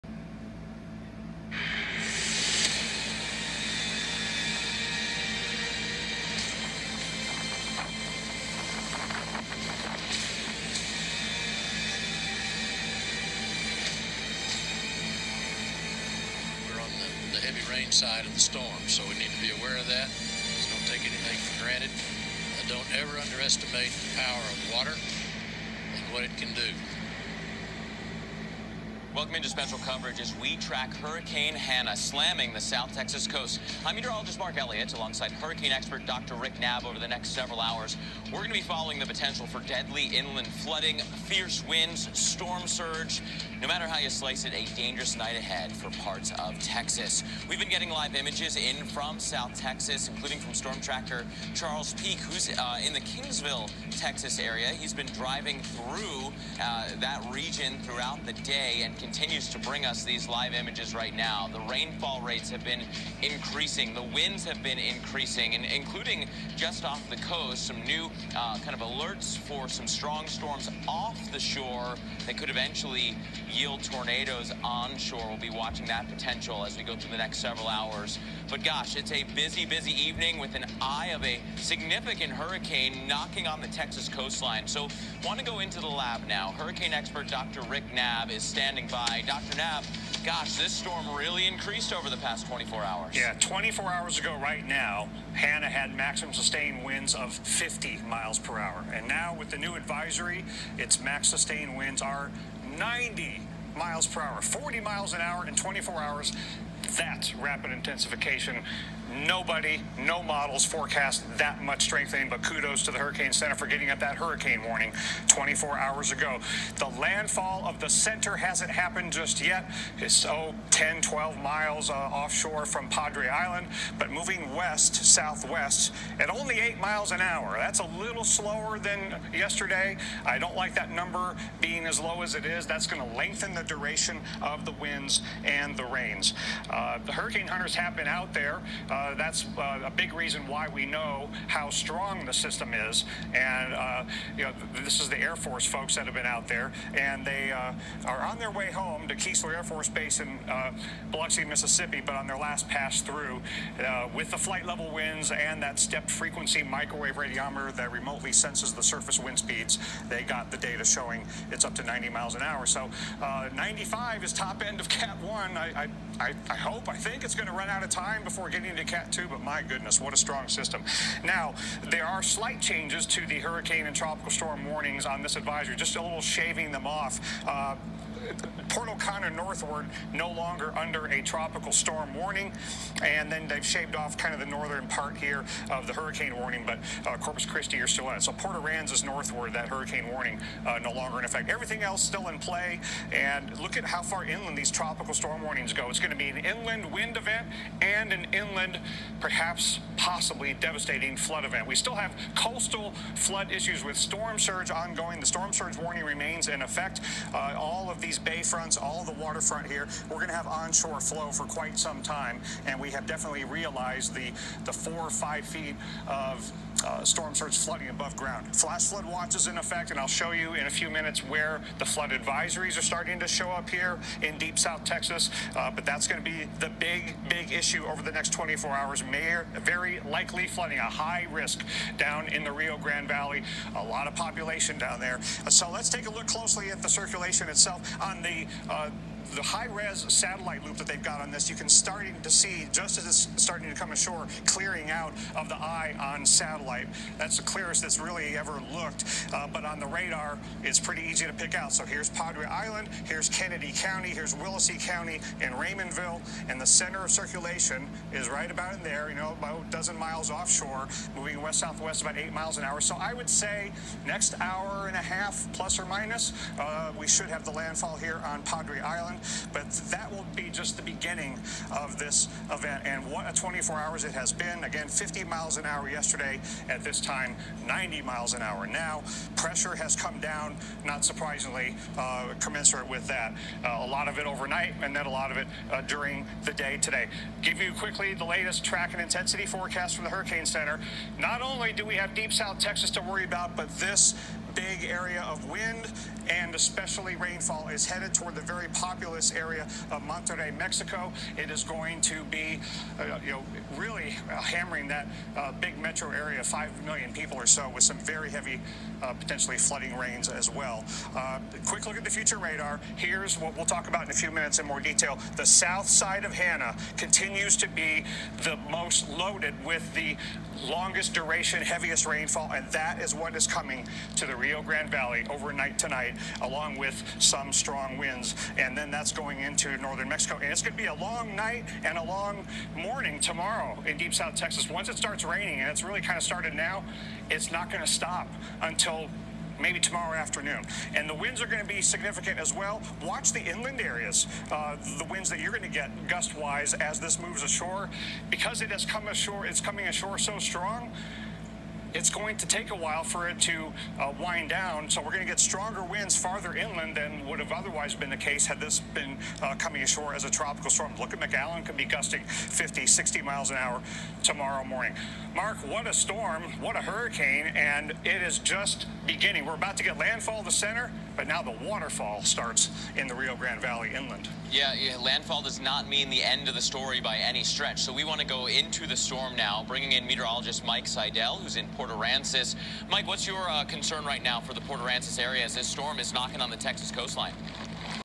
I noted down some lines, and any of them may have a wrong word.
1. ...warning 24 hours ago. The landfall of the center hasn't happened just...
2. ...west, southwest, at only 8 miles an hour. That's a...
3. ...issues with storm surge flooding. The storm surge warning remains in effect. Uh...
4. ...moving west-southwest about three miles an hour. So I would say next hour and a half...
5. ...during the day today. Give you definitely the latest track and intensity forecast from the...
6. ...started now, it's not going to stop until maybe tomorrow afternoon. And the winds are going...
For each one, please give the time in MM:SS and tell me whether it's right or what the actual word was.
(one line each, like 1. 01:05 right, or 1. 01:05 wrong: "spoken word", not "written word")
1. 01:54 right
2. 02:04 right
3. 03:23 wrong: "ongoing", not "flooding"
4. 04:21 wrong: "eight", not "three"
5. 04:45 wrong: "quickly", not "definitely"
6. 05:36 right.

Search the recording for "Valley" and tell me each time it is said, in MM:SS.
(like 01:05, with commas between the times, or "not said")
03:53, 05:24, 06:13.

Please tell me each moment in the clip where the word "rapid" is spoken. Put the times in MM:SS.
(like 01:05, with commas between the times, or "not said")
01:47.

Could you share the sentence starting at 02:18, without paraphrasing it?
Uh, uh, that's uh, a big reason why we know how strong the system is.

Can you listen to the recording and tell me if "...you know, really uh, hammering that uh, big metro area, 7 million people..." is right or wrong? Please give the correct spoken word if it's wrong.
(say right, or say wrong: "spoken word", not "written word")
wrong: "5", not "7".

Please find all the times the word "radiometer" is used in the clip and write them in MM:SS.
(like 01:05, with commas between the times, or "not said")
02:37.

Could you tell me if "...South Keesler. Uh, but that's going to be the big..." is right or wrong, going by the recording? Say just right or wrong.
wrong.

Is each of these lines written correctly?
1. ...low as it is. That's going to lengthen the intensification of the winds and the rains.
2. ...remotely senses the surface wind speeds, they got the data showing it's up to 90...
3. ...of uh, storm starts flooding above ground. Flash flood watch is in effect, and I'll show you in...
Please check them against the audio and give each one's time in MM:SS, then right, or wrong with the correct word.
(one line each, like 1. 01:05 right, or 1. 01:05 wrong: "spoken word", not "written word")
1. 02:11 wrong: "duration", not "intensification"
2. 02:37 right
3. 03:36 right.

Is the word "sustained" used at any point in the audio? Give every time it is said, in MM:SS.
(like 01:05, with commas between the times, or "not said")
01:36, 01:41.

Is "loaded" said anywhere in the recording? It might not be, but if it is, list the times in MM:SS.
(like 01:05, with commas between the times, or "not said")
05:19.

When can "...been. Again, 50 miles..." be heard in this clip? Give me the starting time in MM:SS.
04:34.